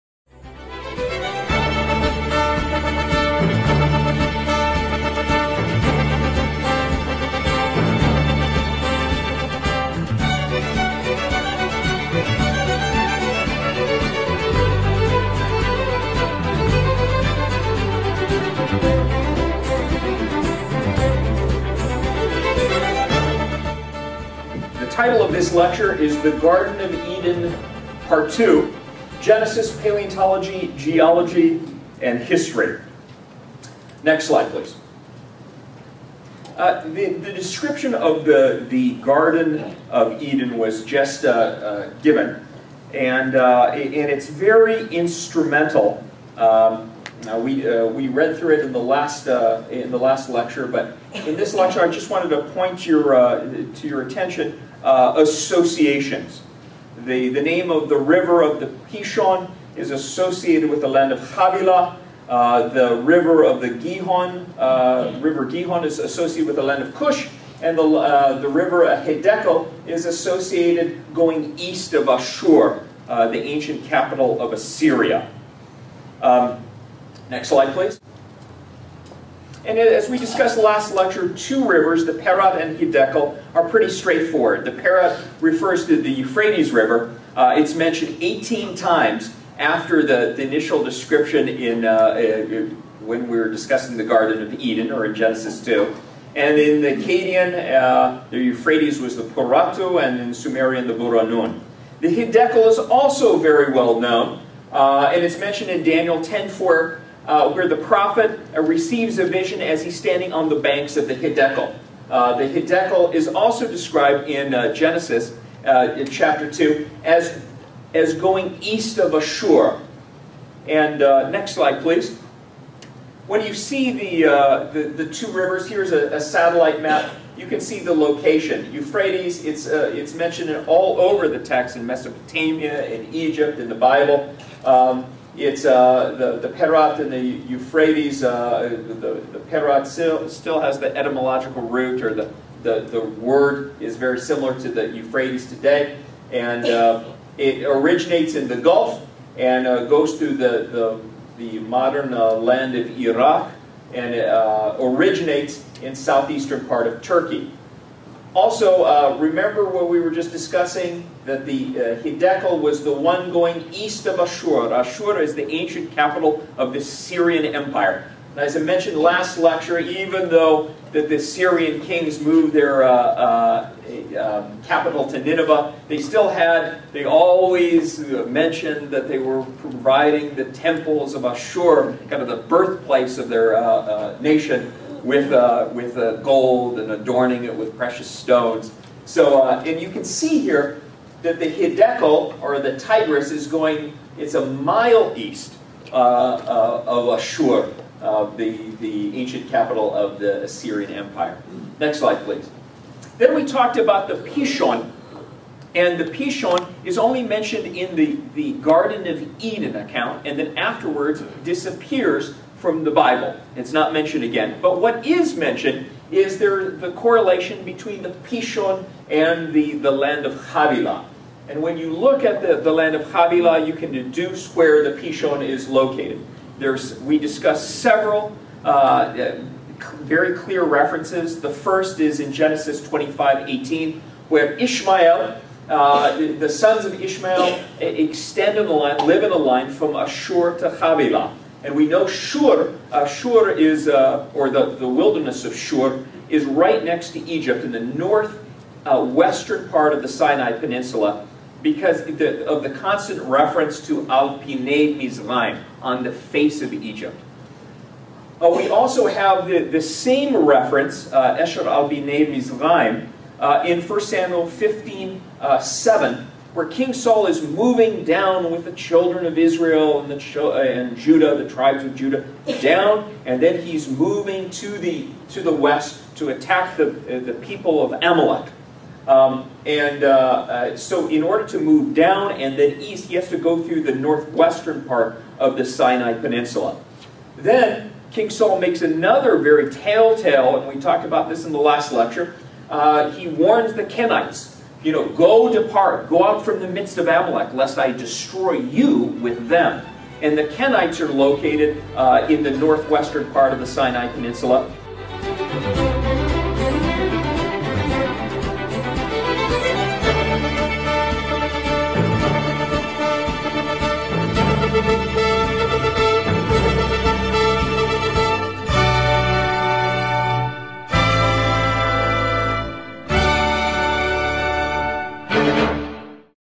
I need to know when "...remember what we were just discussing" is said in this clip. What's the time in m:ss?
2:39.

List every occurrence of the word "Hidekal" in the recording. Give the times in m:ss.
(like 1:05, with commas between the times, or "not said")
1:22, 1:42.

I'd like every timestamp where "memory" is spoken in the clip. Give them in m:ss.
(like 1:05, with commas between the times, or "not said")
not said.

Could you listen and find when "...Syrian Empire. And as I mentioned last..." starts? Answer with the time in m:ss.
2:46.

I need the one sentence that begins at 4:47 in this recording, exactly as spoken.
Then, King Saul makes another very telltale, and we talked about this in the last lecture.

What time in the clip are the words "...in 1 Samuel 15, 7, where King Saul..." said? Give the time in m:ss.
4:23.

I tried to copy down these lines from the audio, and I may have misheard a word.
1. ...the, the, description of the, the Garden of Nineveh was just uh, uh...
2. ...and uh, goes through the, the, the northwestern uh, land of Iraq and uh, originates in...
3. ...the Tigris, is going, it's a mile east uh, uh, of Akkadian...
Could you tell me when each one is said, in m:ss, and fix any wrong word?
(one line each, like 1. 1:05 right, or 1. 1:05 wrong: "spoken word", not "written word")
1. 0:36 wrong: "Eden", not "Nineveh"
2. 2:29 wrong: "modern", not "northwestern"
3. 3:12 wrong: "Ashur", not "Akkadian".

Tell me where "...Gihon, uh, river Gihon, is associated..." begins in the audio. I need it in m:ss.
1:03.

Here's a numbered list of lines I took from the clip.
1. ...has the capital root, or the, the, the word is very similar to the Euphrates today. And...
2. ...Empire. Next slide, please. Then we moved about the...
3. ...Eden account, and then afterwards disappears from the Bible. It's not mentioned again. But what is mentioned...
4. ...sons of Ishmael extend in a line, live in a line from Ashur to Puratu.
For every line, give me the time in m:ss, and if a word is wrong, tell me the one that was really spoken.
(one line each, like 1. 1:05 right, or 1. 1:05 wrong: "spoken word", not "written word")
1. 2:20 wrong: "etymological", not "capital"
2. 3:20 wrong: "talked", not "moved"
3. 3:29 right
4. 3:56 wrong: "Havilah", not "Puratu".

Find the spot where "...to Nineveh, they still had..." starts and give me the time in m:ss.
2:55.